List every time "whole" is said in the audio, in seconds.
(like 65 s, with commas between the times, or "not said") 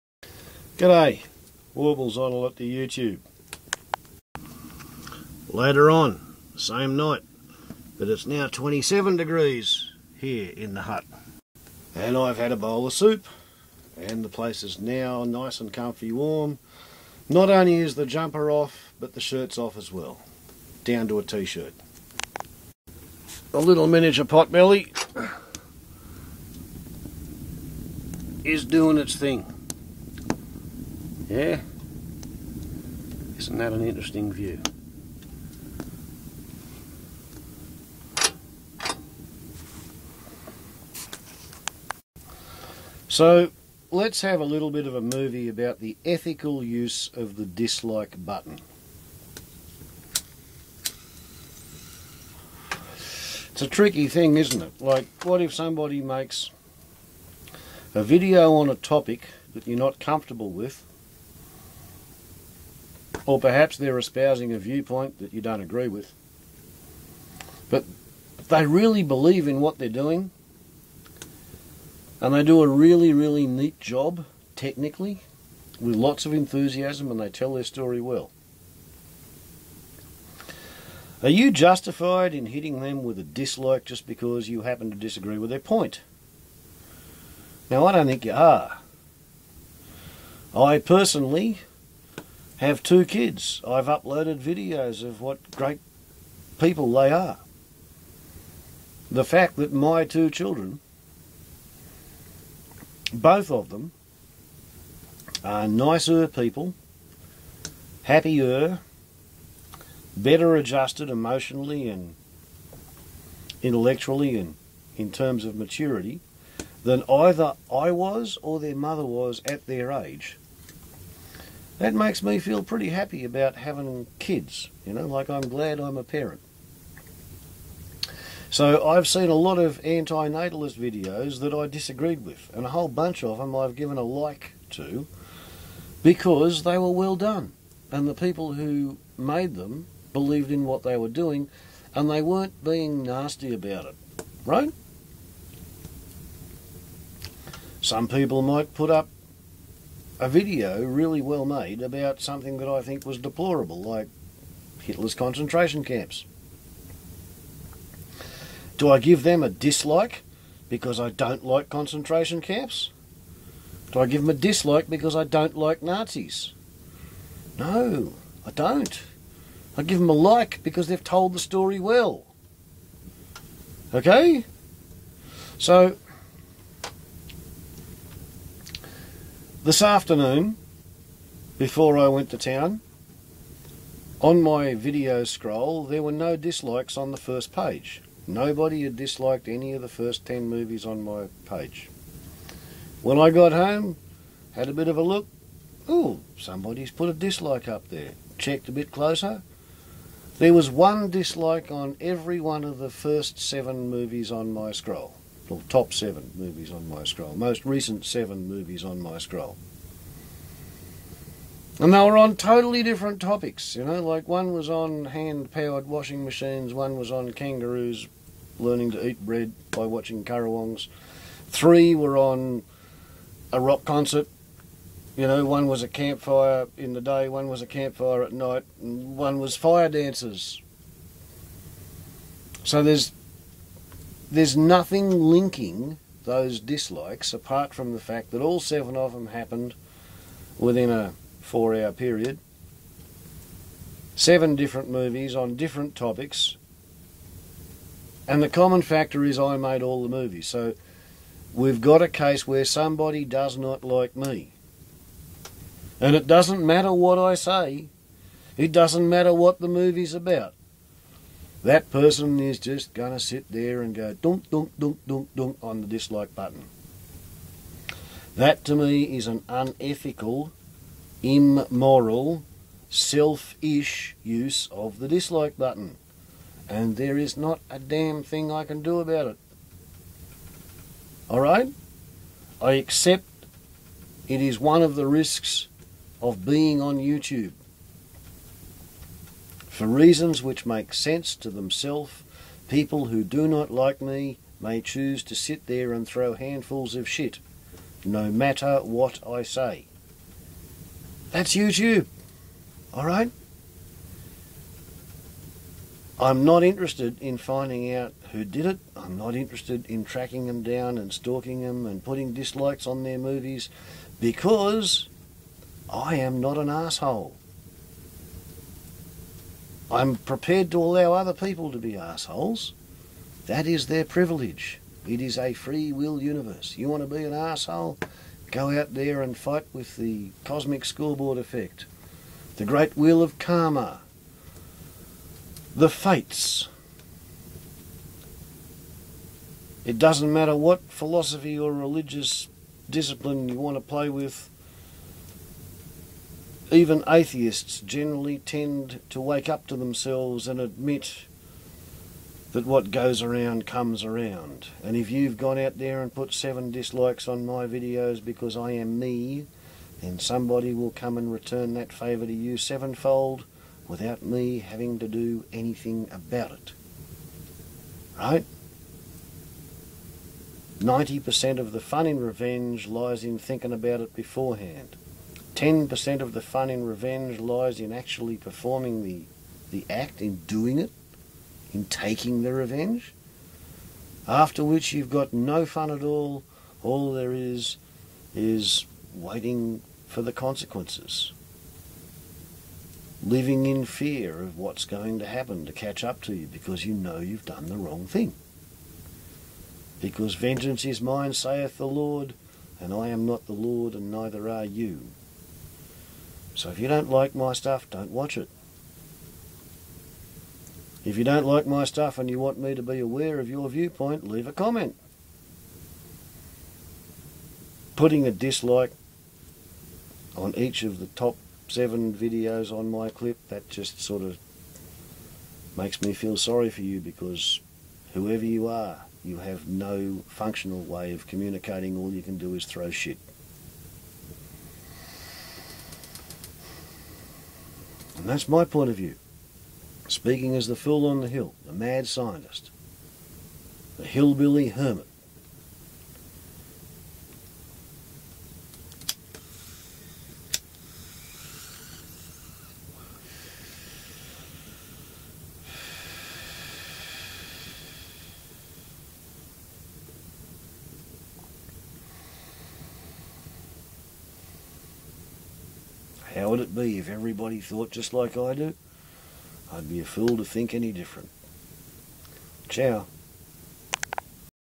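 132 s.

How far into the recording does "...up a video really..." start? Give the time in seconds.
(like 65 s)
148 s.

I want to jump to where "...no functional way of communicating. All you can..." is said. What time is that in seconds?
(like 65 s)
429 s.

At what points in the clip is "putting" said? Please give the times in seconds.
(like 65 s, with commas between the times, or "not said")
312 s, 417 s.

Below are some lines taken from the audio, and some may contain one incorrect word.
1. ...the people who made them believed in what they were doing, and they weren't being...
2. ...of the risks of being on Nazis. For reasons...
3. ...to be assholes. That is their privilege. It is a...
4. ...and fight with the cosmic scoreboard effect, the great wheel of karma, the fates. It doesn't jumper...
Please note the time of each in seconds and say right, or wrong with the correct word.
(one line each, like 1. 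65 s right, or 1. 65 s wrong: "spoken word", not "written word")
1. 138 s right
2. 284 s wrong: "YouTube", not "Nazis"
3. 321 s right
4. 329 s wrong: "matter", not "jumper".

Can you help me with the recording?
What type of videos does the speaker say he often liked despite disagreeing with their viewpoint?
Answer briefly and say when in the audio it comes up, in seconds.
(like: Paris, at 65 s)
antinatalist videos, at 129 s.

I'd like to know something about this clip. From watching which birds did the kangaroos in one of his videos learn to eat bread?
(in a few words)
currawongs.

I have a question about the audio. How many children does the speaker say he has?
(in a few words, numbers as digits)
2.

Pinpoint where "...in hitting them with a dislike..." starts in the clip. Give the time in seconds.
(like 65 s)
82 s.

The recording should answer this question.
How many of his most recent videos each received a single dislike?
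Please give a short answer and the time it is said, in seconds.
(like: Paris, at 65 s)
7, at 202 s.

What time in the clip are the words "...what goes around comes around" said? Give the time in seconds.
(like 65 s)
352 s.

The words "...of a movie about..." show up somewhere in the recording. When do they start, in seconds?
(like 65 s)
44 s.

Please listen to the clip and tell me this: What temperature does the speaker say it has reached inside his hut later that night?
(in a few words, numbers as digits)
27 degrees.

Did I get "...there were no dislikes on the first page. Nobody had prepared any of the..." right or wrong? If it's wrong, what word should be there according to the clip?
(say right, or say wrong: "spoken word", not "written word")
wrong: "disliked", not "prepared".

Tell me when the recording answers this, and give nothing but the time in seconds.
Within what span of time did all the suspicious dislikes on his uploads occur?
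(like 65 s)
241 s.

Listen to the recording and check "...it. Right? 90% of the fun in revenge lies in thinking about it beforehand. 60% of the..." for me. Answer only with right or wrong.
wrong.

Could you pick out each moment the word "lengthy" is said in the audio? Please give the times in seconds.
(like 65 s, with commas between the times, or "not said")
not said.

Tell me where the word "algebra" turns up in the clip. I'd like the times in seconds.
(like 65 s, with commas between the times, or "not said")
not said.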